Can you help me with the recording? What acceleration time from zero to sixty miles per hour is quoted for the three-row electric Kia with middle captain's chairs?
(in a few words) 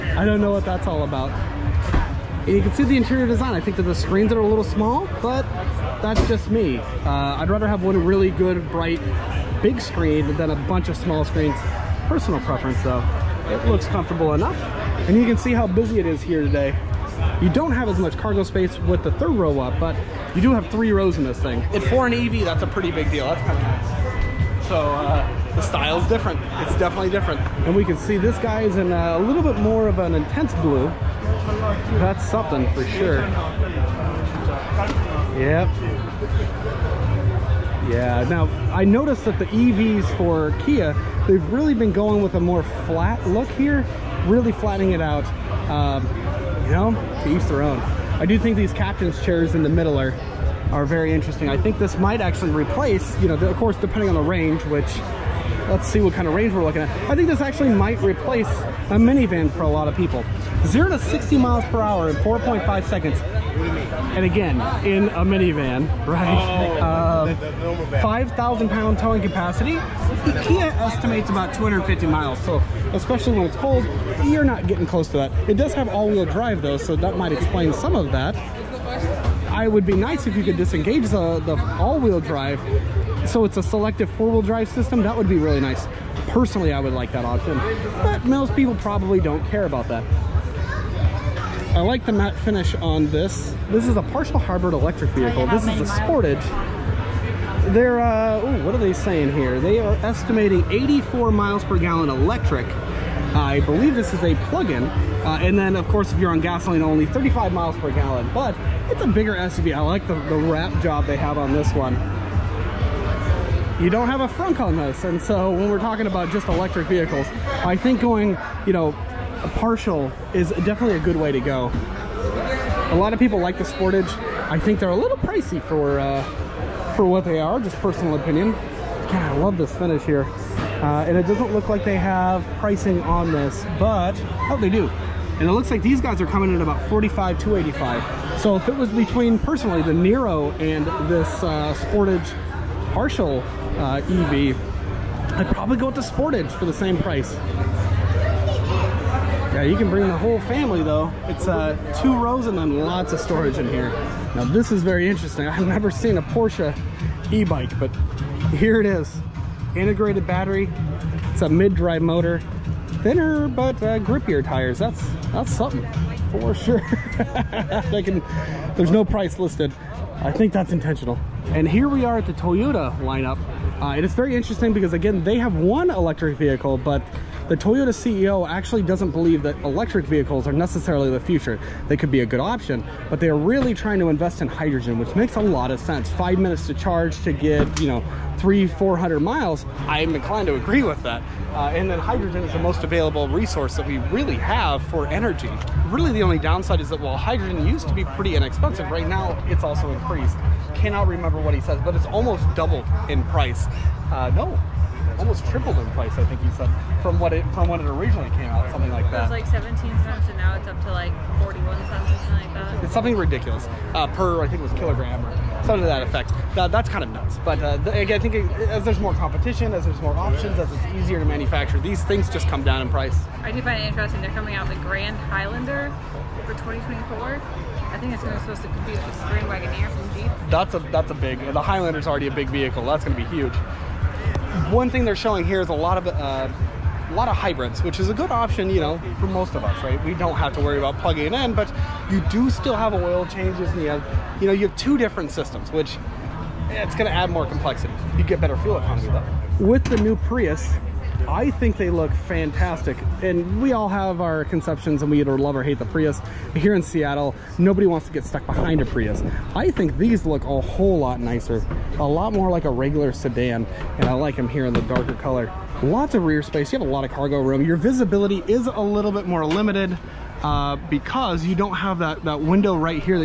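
4.5 seconds.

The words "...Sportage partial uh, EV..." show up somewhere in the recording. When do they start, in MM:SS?
02:21.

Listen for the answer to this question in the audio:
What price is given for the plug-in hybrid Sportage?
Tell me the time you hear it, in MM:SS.
02:16.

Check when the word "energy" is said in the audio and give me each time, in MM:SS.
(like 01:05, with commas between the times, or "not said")
03:15.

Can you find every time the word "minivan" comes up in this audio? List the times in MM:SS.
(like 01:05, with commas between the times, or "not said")
00:58, 01:05.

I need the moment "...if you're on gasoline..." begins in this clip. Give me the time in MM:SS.
01:46.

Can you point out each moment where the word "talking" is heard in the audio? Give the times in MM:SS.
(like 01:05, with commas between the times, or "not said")
01:55.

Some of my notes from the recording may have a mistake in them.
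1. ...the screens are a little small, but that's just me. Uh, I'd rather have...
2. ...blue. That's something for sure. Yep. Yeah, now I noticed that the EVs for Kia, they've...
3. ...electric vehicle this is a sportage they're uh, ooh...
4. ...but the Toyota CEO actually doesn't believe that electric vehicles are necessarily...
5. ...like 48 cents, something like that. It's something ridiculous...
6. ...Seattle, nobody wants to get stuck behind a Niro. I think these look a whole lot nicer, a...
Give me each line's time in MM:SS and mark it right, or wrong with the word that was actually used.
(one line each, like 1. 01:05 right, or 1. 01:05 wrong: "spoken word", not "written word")
1. 00:03 right
2. 00:30 right
3. 01:34 right
4. 02:56 right
5. 03:30 wrong: "41", not "48"
6. 04:16 wrong: "Prius", not "Niro".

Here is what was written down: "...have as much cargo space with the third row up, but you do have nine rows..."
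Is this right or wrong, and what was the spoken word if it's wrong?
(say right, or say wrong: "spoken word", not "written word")
wrong: "three", not "nine".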